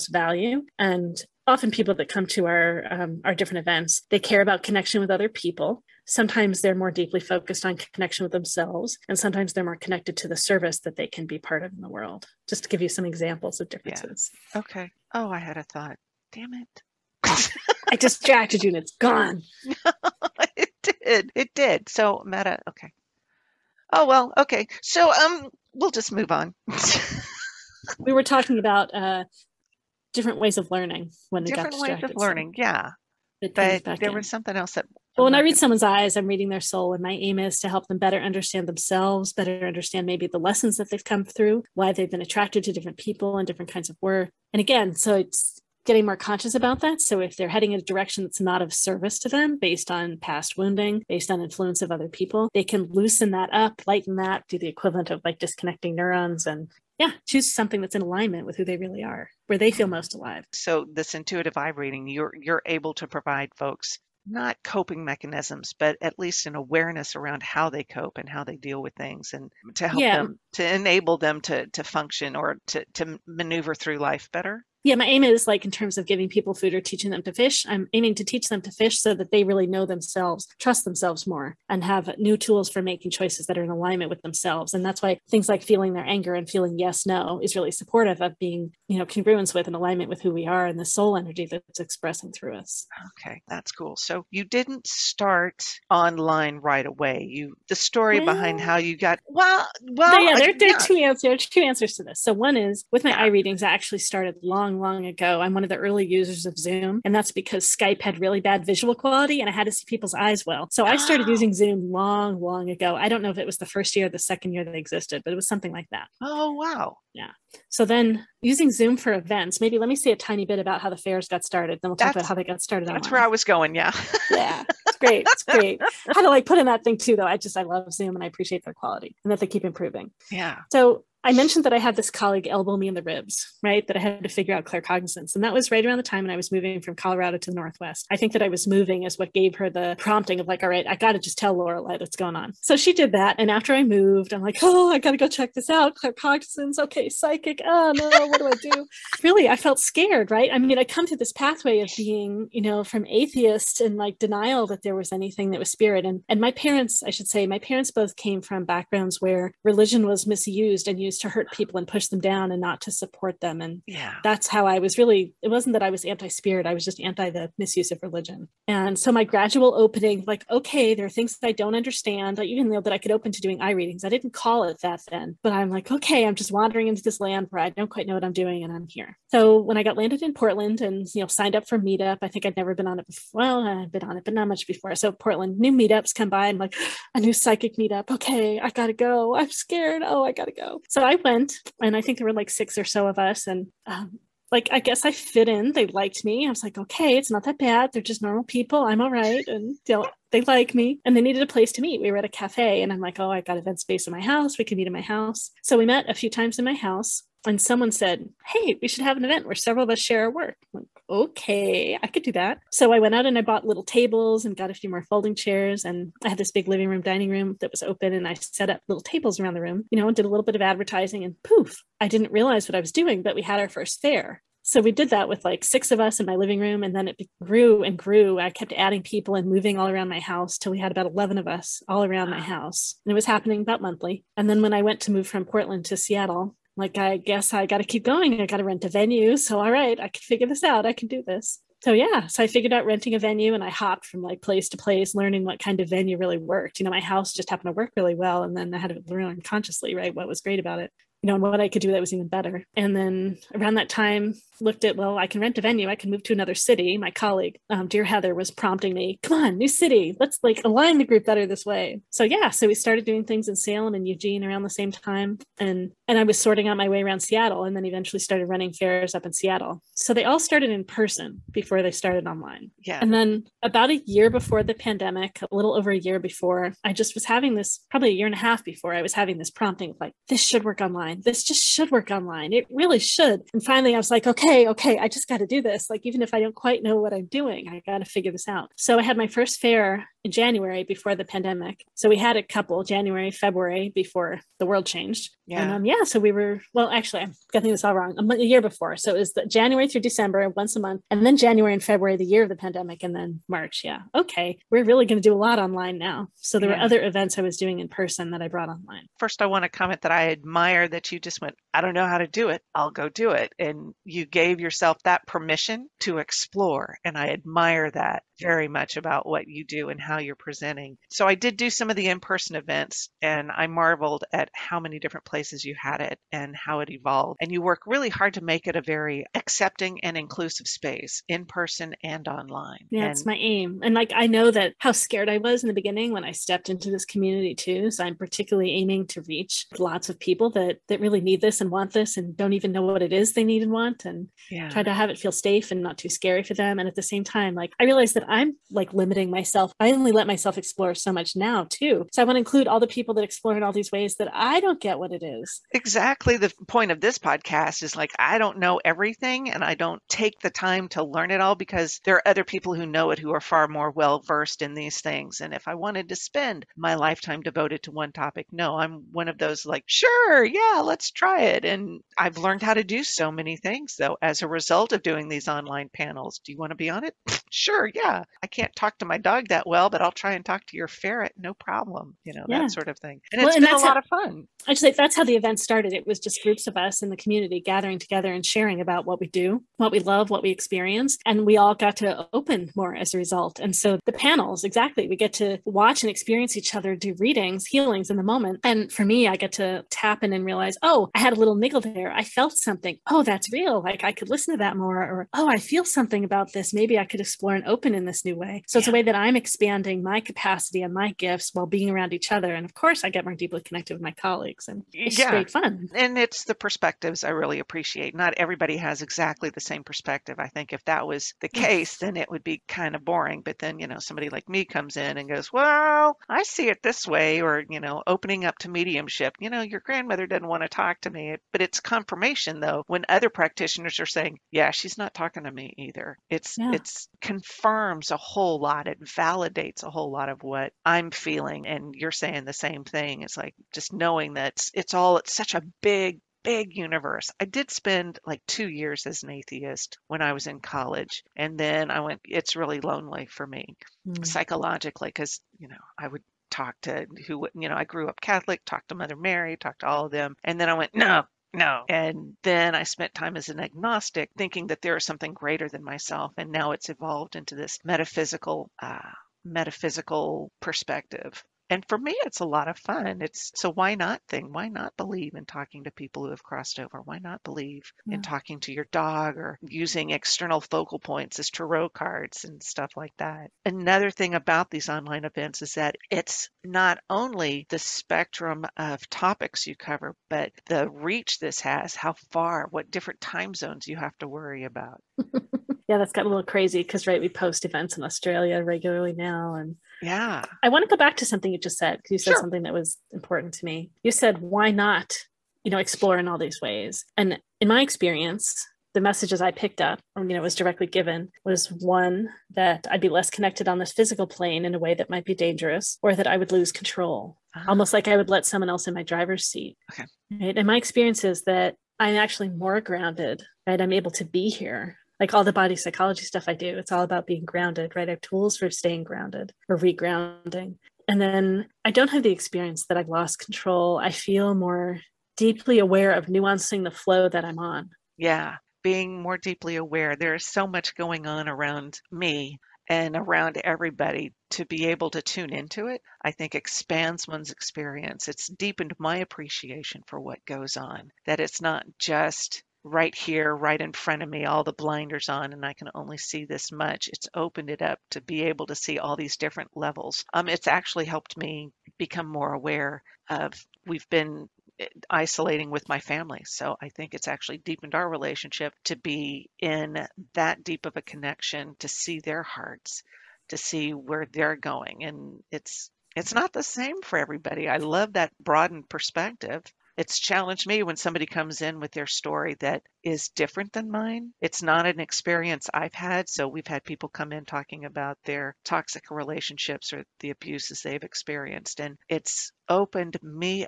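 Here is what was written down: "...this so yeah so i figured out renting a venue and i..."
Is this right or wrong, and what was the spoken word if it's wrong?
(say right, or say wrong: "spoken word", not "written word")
right.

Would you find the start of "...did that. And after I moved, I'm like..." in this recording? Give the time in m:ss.
2:22.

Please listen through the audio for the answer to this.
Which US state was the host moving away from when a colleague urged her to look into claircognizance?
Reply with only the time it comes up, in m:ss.
2:16.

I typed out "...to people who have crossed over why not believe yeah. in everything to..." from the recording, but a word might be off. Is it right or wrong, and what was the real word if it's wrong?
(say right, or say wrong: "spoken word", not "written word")
wrong: "talking", not "everything".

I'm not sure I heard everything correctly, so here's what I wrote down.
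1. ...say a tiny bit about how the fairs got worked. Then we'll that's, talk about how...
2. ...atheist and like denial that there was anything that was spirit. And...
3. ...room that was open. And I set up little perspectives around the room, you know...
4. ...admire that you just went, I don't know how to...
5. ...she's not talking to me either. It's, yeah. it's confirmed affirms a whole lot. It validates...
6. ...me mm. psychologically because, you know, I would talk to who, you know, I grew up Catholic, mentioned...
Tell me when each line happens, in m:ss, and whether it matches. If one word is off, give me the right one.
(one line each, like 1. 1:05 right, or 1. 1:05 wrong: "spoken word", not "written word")
1. 1:59 wrong: "started", not "worked"
2. 2:33 right
3. 3:37 wrong: "tables", not "perspectives"
4. 5:10 right
5. 7:14 right
6. 7:33 wrong: "talked", not "mentioned".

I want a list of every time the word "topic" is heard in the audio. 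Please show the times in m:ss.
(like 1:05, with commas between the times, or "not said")
6:08, 8:09.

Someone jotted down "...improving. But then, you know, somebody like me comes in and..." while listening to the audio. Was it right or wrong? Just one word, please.
wrong.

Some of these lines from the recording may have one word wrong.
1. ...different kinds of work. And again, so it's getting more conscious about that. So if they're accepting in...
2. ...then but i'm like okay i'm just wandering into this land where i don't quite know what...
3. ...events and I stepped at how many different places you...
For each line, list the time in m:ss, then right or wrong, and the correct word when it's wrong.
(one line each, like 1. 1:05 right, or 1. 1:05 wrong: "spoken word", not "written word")
1. 0:43 wrong: "heading", not "accepting"
2. 2:55 right
3. 5:22 wrong: "marveled", not "stepped".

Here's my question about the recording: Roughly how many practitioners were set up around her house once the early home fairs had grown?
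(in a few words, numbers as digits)
11.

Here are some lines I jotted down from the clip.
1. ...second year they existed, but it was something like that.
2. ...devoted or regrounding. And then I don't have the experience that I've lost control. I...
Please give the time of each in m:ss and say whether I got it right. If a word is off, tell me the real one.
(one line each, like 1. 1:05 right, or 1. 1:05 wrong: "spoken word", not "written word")
1. 1:54 right
2. 8:49 wrong: "grounded", not "devoted".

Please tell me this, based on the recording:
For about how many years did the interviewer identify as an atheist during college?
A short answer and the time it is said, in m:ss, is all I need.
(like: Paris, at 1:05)
2 years, at 7:28.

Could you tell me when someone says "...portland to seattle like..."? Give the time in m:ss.
3:55.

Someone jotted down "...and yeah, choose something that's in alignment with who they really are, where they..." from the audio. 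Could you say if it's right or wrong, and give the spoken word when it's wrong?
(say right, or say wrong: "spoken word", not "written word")
right.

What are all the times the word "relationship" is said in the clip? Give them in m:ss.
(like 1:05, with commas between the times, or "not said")
9:28, 9:49.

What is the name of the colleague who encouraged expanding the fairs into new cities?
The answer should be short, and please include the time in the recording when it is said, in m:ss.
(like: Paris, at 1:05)
Heather, at 4:18.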